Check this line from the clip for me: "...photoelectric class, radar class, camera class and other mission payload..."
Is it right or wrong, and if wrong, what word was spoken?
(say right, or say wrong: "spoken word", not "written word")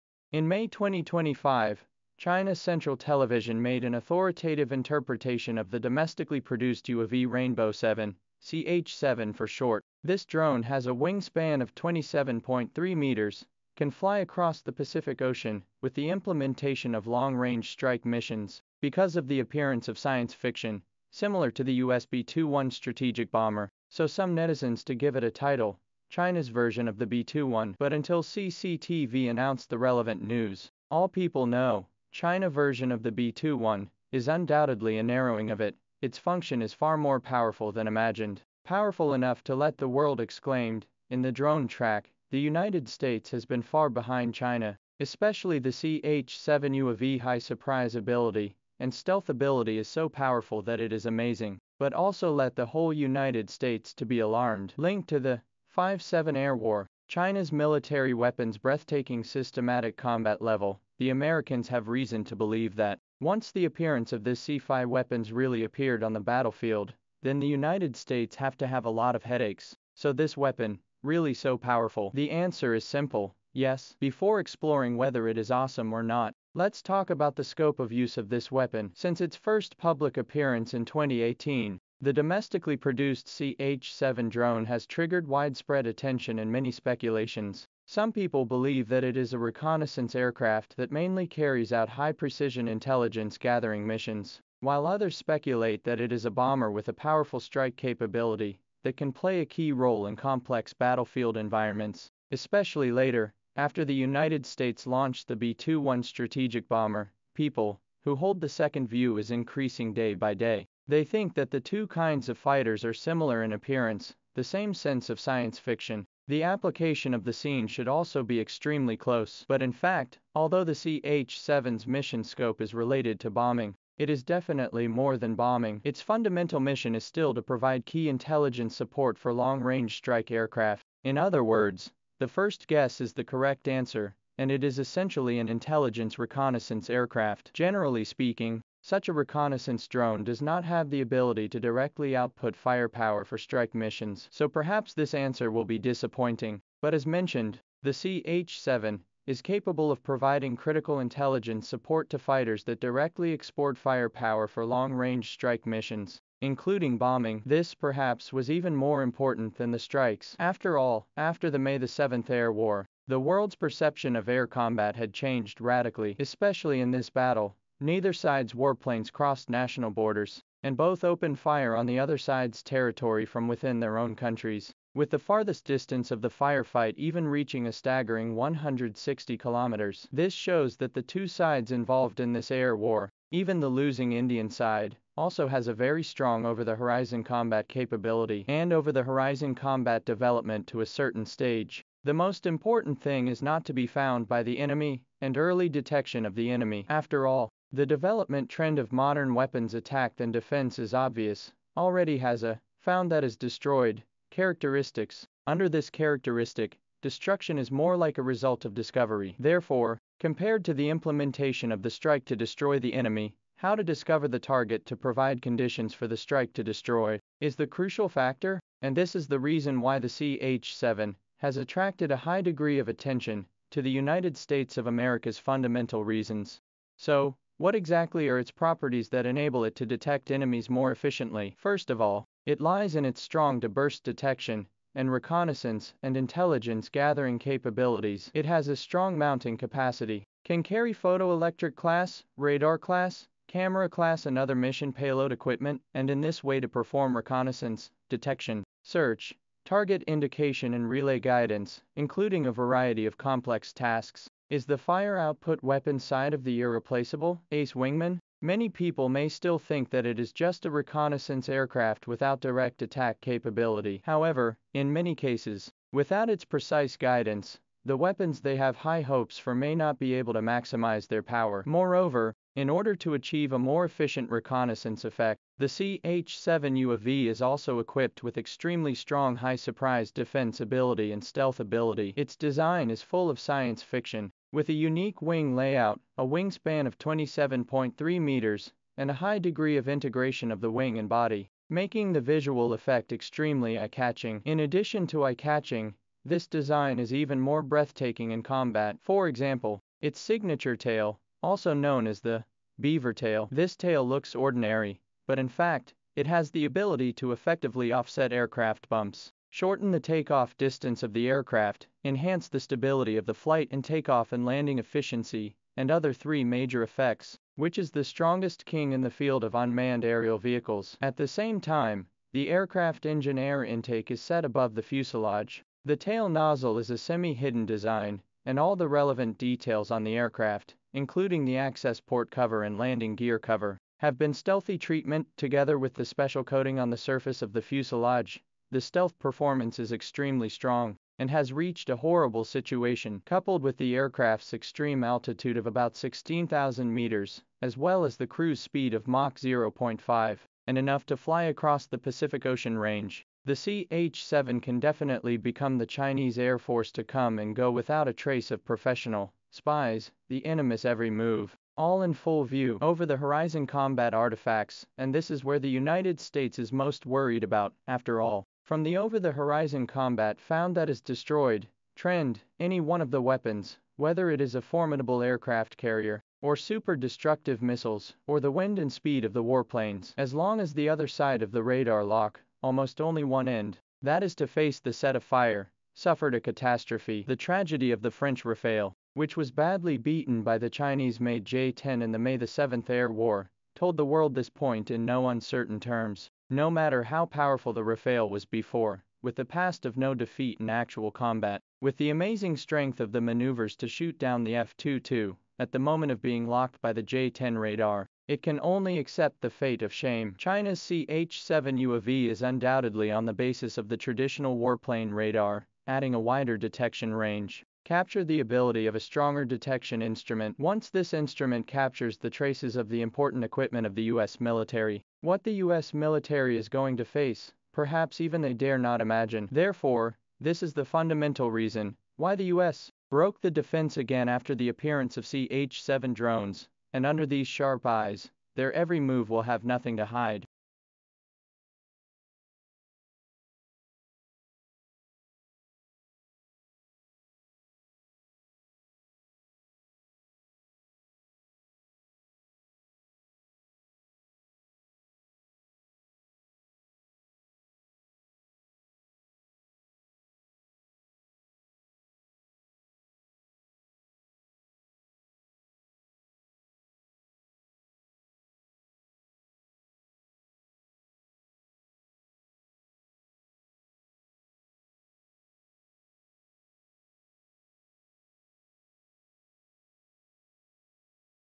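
right.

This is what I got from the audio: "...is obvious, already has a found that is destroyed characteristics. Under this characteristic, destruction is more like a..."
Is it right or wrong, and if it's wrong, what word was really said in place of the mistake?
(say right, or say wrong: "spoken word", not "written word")
right.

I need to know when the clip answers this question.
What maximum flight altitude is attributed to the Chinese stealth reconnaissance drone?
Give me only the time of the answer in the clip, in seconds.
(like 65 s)
345 s.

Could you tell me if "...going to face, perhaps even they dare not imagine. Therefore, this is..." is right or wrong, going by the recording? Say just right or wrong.
right.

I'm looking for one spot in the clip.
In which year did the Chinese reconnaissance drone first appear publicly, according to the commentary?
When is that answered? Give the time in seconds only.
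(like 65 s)
80 s.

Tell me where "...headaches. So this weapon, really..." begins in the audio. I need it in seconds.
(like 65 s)
69 s.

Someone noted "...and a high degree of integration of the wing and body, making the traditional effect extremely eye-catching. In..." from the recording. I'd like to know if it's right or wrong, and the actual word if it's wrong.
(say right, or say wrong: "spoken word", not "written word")
wrong: "visual", not "traditional".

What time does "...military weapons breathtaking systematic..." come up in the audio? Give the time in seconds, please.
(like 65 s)
57 s.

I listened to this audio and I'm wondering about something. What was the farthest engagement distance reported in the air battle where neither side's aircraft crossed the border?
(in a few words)
160 kilometers.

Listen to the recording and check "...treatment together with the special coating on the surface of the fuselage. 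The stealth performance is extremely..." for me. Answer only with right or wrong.
right.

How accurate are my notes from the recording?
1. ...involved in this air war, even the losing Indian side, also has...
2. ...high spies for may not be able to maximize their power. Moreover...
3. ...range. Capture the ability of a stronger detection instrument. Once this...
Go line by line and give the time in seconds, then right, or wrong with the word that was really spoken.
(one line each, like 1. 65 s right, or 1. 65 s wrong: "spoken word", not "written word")
1. 181 s right
2. 268 s wrong: "hopes", not "spies"
3. 417 s right.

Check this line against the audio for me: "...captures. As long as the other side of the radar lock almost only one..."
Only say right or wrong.
wrong.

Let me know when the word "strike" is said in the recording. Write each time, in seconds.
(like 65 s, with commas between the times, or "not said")
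17 s, 97 s, 129 s, 143 s, 155 s, 159 s, 211 s, 216 s.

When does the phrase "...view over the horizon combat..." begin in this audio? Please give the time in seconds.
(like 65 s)
362 s.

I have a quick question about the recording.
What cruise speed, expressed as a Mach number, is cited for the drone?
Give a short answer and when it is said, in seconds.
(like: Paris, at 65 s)
Mach 0.5, at 349 s.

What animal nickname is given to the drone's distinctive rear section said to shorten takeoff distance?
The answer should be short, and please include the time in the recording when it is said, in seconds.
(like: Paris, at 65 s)
beaver tail, at 302 s.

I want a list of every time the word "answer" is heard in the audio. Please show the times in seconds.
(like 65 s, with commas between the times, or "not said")
72 s, 133 s, 145 s.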